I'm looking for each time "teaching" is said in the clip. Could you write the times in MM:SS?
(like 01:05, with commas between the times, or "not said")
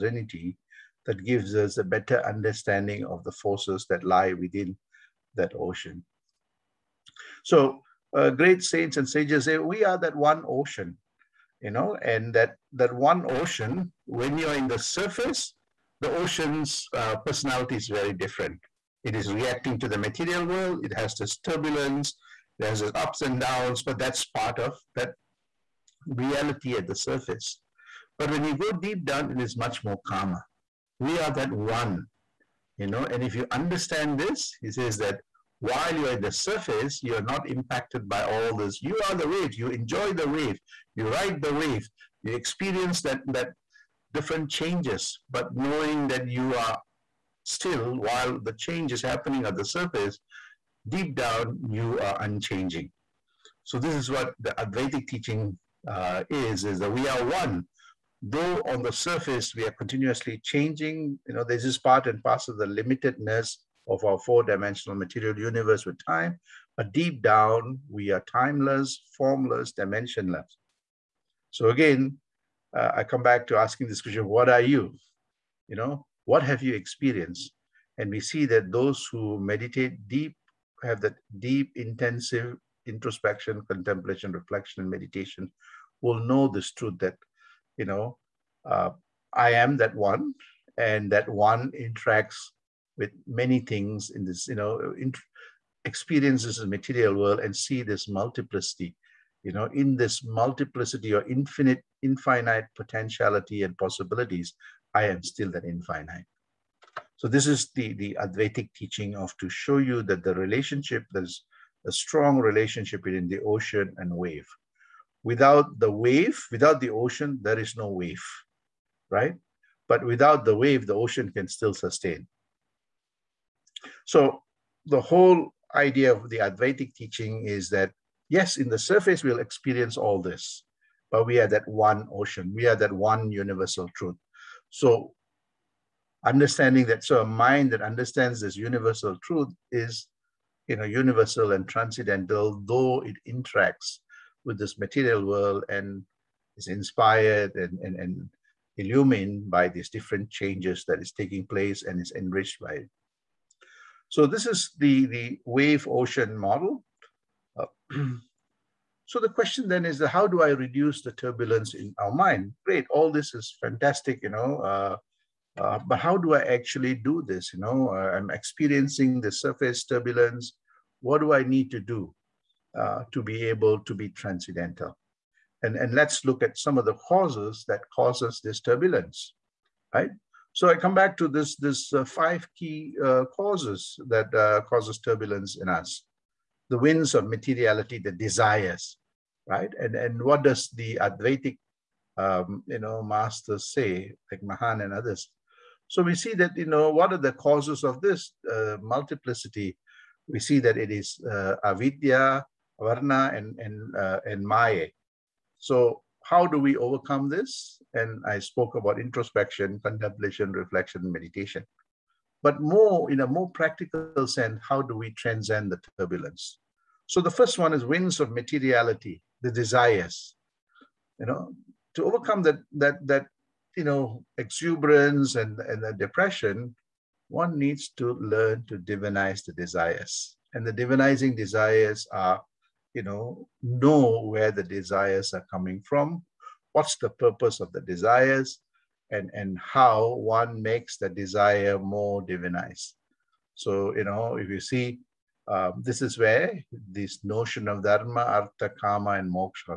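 00:55, 01:48, 02:06.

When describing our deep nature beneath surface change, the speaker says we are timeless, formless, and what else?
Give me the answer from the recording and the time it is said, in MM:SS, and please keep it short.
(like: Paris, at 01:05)
dimensionless, at 01:09.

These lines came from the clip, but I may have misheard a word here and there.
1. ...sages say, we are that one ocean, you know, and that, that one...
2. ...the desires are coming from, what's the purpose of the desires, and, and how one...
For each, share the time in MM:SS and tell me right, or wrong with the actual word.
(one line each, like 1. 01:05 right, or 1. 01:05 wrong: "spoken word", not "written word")
1. 00:09 right
2. 03:54 right.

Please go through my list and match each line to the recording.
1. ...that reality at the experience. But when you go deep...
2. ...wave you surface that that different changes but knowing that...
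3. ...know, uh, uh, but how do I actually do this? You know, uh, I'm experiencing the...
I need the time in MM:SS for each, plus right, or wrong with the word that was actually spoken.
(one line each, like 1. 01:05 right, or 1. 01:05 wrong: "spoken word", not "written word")
1. 00:24 wrong: "surface", not "experience"
2. 00:41 wrong: "experience", not "surface"
3. 02:44 right.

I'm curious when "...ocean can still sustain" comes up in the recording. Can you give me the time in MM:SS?
02:01.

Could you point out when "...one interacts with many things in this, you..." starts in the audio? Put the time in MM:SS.
01:31.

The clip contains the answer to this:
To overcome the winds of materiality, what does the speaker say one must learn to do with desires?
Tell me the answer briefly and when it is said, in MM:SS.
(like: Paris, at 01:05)
divinize the desires, at 03:48.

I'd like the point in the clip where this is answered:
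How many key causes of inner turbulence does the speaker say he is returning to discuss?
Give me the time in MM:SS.
03:02.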